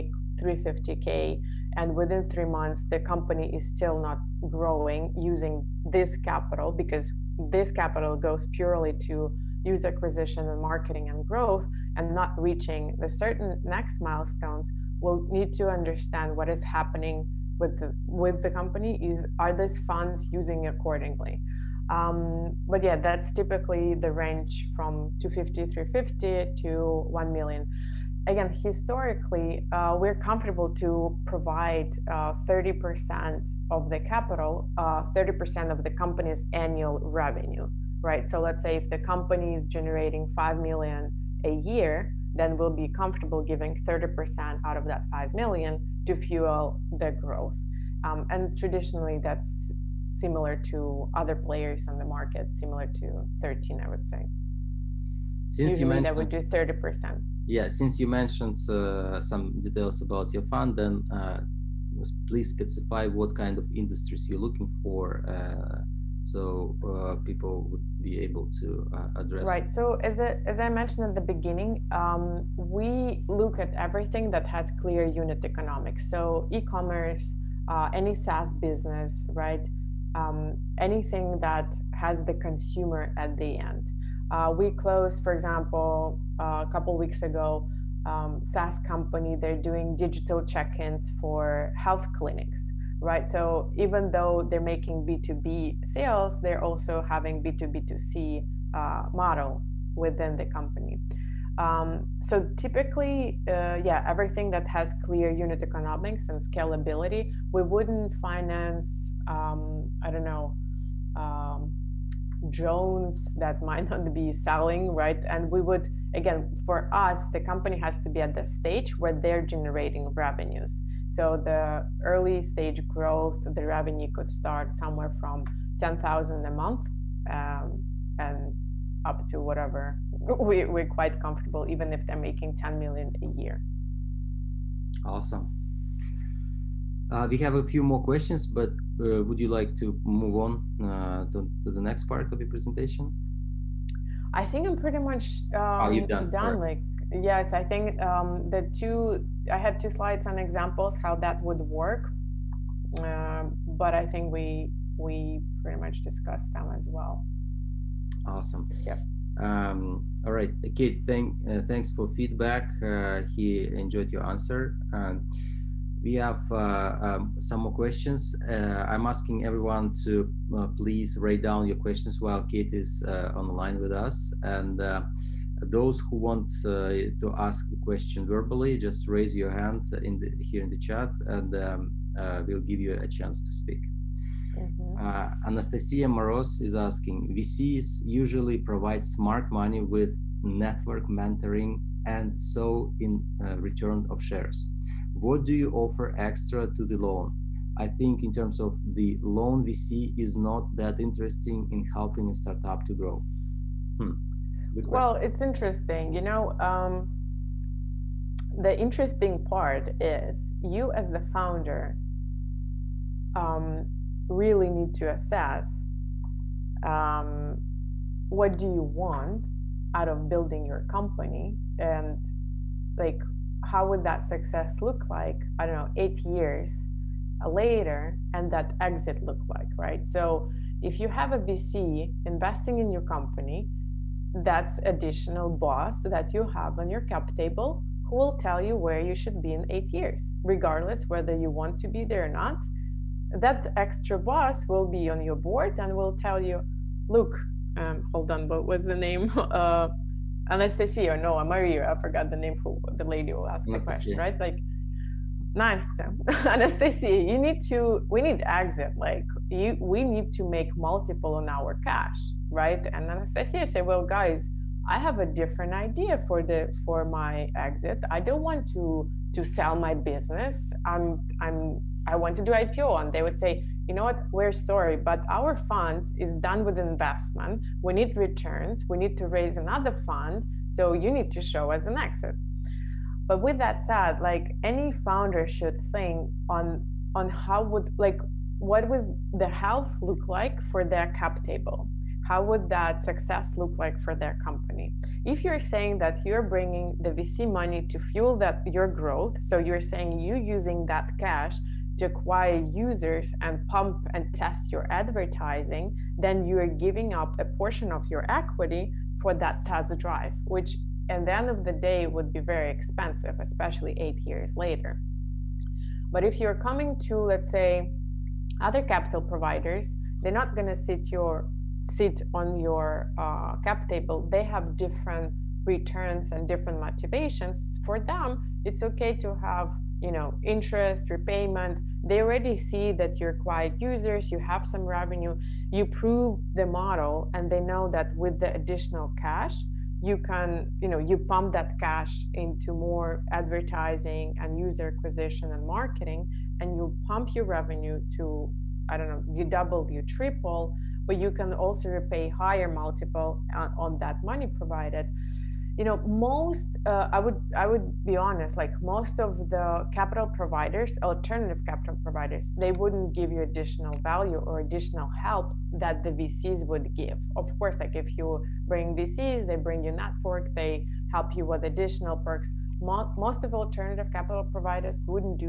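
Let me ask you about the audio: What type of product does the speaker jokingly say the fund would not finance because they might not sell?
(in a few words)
drones.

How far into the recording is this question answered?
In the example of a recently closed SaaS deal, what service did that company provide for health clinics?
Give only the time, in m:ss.
1:29.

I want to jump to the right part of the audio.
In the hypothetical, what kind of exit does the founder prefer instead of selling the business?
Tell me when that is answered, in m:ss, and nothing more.
4:32.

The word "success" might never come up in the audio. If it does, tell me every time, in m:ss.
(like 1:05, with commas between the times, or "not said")
3:44, 4:53.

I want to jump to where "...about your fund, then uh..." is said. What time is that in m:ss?
1:00.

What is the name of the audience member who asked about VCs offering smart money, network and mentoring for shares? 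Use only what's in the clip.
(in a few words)
Anastasia Moros.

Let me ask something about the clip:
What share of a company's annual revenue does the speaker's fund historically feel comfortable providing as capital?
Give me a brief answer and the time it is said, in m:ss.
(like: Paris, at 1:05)
30%, at 0:34.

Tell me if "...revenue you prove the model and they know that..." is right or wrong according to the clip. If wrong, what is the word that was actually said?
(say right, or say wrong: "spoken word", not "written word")
right.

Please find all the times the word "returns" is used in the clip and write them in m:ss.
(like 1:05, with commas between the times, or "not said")
3:13, 4:38, 5:25.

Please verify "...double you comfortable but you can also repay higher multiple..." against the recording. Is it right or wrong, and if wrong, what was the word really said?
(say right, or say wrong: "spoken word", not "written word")
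wrong: "triple", not "comfortable".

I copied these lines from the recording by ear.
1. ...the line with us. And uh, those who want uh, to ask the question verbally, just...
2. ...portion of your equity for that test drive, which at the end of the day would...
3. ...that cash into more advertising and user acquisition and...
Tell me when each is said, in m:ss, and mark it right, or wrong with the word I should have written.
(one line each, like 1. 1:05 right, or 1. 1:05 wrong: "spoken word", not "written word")
1. 2:53 right
2. 5:07 right
3. 5:41 right.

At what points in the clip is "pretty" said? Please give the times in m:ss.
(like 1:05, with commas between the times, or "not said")
2:24, 2:35.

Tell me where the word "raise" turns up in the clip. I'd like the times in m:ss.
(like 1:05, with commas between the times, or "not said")
2:59, 4:39.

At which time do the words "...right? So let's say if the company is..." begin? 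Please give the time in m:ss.
0:38.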